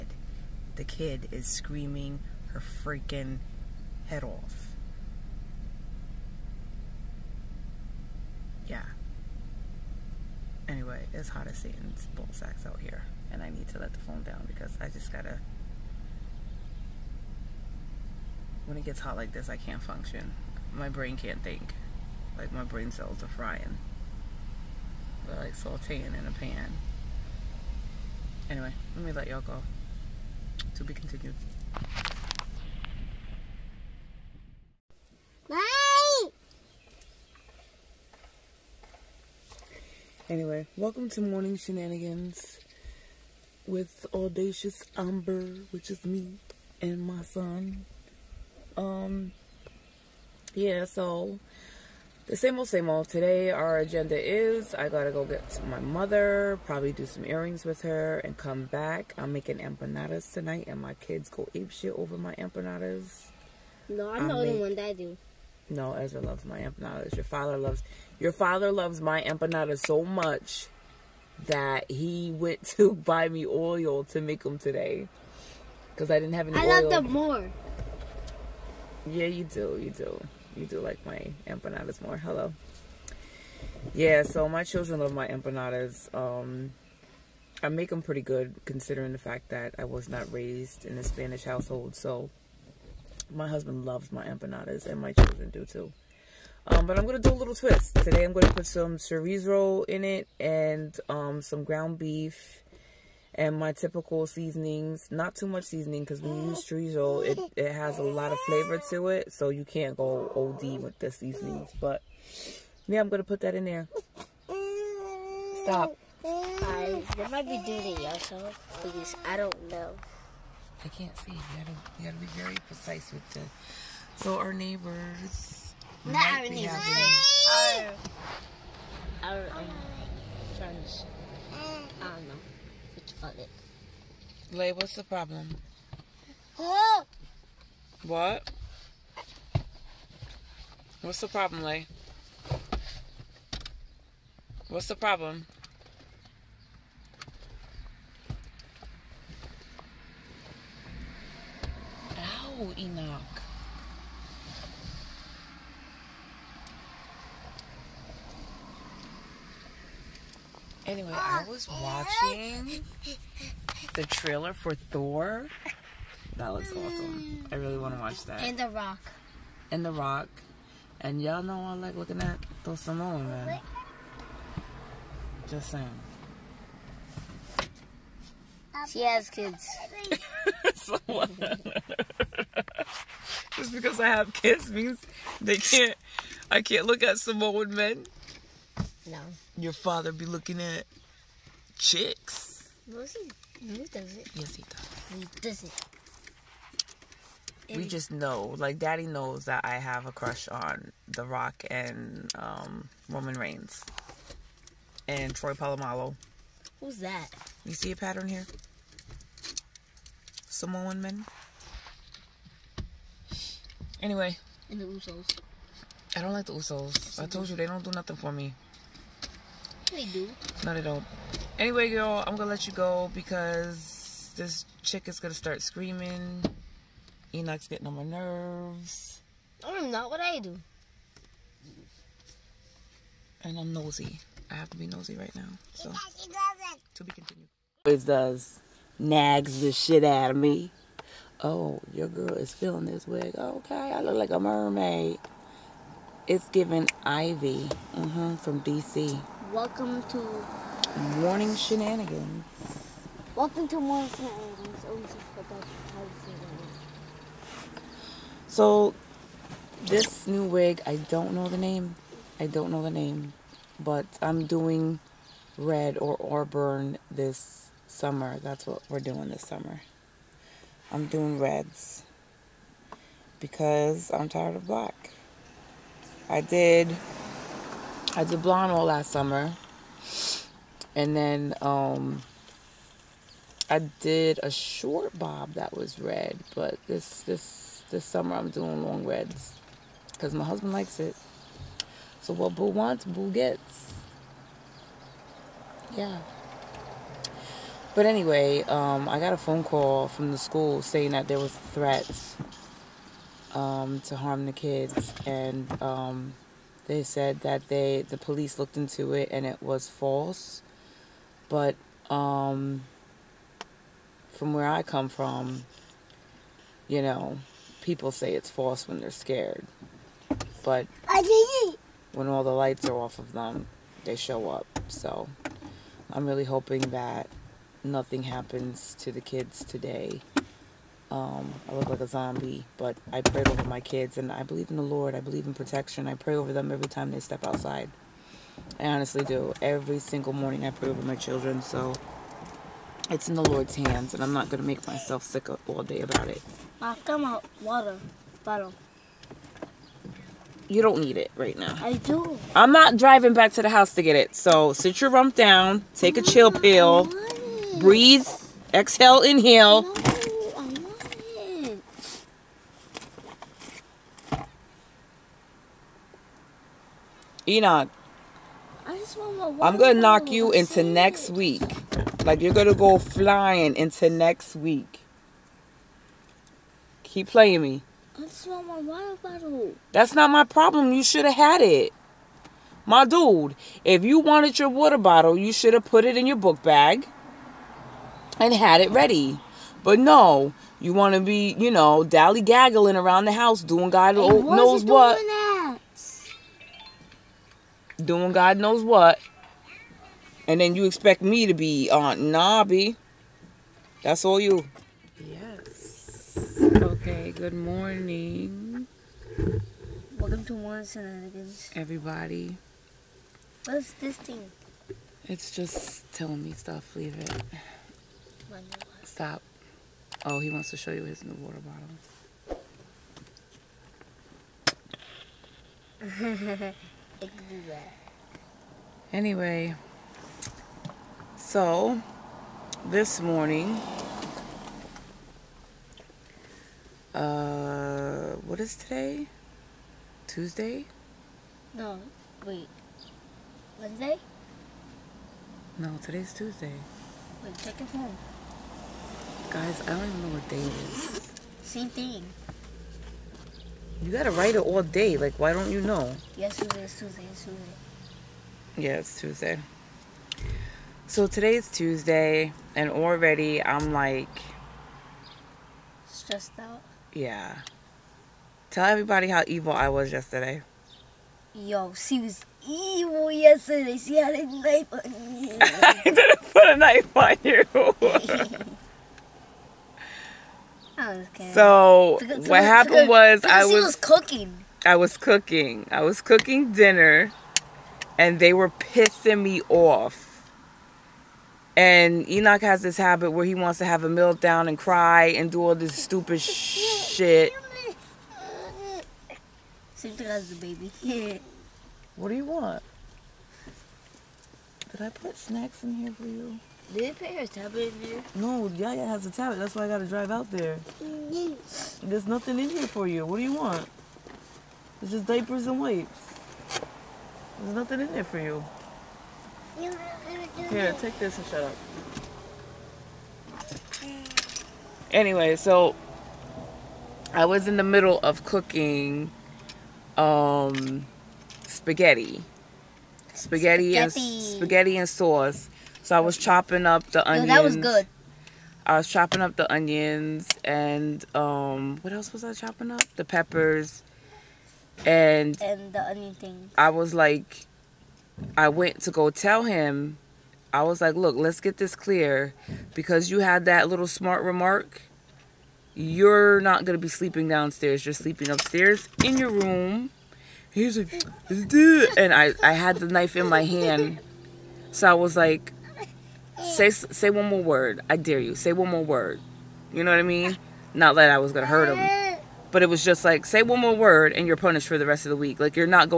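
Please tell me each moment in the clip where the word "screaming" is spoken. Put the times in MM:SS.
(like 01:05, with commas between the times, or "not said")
00:01, 03:45.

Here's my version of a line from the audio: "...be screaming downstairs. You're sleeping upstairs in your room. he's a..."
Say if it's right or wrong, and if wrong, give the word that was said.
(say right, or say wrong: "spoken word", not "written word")
wrong: "sleeping", not "screaming".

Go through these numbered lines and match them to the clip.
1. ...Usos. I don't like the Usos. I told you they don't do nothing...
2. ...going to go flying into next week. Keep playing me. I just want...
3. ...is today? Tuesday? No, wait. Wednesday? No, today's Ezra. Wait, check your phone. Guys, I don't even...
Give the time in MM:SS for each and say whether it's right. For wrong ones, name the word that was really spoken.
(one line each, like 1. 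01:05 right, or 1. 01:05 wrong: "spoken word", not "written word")
1. 03:34 right
2. 06:12 right
3. 07:18 wrong: "Tuesday", not "Ezra".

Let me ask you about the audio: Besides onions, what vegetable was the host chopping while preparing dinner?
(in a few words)
Peppers.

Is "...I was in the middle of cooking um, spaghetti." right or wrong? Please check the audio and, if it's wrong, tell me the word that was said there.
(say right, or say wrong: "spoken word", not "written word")
right.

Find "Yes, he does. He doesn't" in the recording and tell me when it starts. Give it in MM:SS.
03:14.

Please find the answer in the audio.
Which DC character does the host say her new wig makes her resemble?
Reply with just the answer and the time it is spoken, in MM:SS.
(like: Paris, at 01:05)
Ivy, at 04:07.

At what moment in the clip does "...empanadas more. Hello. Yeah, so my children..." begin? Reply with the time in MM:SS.
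01:21.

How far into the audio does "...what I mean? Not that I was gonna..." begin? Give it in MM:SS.
09:30.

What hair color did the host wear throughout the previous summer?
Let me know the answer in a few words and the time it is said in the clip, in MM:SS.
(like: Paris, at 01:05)
Blonde, at 04:38.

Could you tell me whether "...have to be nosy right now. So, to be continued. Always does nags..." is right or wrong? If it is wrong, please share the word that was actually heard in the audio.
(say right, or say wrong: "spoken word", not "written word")
right.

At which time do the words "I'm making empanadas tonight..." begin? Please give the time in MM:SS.
00:59.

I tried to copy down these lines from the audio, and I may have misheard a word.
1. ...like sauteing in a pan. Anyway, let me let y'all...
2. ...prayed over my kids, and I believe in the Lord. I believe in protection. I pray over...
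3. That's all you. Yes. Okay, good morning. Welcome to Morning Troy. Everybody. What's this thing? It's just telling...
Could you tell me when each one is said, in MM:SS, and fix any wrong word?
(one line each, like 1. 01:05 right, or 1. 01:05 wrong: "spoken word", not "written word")
1. 00:25 right
2. 05:33 right
3. 06:44 wrong: "Shenanigans", not "Troy".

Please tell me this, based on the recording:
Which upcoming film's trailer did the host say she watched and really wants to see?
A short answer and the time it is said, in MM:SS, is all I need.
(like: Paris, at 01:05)
Thor, at 02:44.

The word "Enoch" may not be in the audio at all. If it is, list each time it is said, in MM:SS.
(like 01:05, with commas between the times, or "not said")
02:32, 03:47, 06:07, 08:12.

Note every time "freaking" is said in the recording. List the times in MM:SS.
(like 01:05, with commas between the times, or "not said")
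00:02.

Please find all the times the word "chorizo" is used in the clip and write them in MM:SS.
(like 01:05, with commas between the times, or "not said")
01:38, 01:46.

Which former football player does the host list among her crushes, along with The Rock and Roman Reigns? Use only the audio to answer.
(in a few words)
Troy Polamalu.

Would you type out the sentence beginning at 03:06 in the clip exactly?
I can't look at Samoan men.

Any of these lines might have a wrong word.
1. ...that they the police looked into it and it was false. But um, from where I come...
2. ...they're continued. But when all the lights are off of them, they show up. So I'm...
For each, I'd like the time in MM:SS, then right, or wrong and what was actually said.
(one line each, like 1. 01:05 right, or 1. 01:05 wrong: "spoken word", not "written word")
1. 05:07 right
2. 05:18 wrong: "scared", not "continued".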